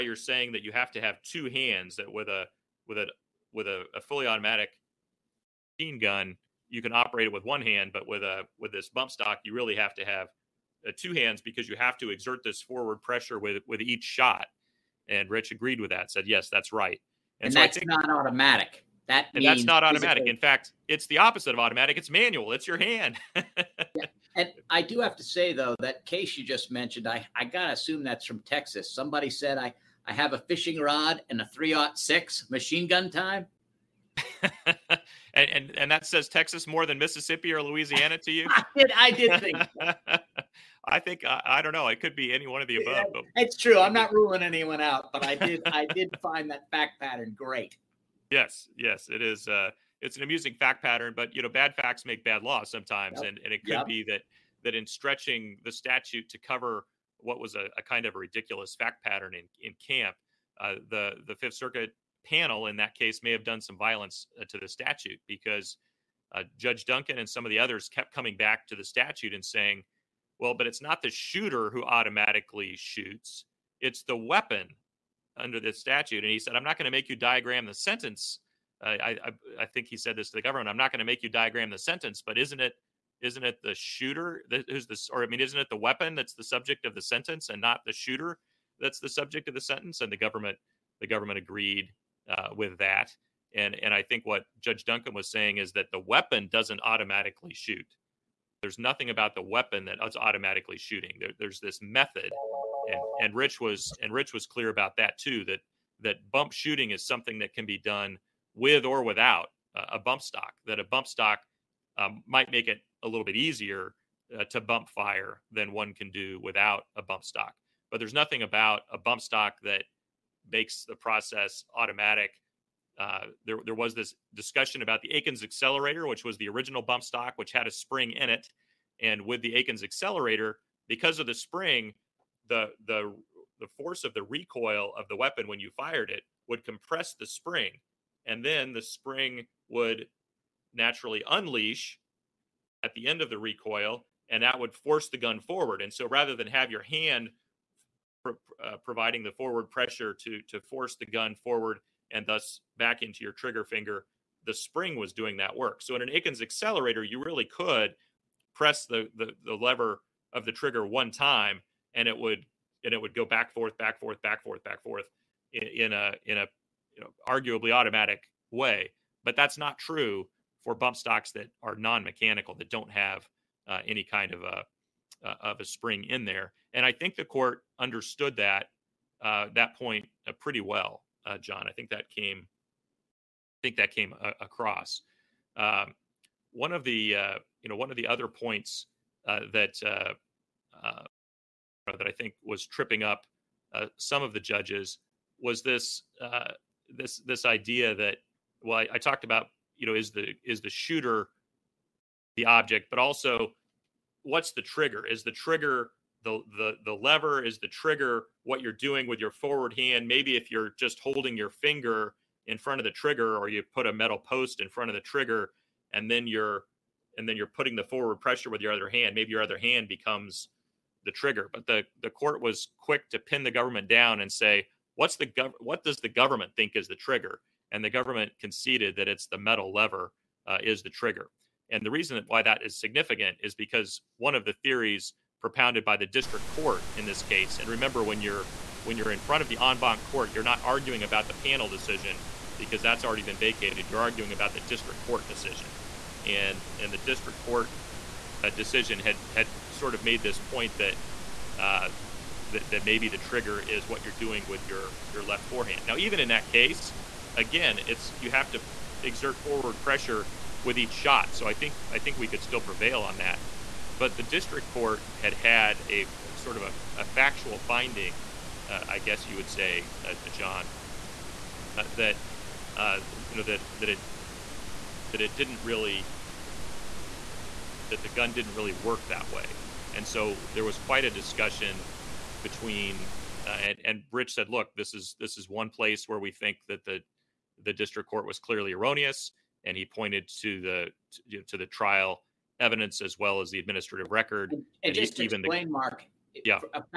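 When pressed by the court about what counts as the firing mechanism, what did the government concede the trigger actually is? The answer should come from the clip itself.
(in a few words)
the metal lever.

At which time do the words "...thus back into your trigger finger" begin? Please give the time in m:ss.
2:32.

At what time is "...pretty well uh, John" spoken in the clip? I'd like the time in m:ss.
3:00.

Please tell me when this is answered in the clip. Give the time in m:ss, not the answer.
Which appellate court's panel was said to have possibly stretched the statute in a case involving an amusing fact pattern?
1:01.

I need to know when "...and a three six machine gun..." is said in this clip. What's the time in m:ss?
0:31.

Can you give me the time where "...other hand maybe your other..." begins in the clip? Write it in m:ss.
3:38.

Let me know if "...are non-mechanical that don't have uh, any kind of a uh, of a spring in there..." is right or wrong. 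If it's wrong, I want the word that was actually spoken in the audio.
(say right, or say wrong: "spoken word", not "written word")
right.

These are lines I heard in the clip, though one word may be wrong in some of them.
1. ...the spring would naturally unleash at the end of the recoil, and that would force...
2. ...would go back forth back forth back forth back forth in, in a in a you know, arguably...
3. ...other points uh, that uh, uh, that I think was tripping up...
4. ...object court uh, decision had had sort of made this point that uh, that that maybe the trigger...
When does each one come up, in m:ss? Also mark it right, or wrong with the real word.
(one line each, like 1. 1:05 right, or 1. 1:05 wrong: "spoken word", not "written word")
1. 2:18 right
2. 2:43 right
3. 3:08 right
4. 4:06 wrong: "district", not "object".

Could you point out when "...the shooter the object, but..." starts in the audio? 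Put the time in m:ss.
3:20.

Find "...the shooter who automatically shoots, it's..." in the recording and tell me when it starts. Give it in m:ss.
1:11.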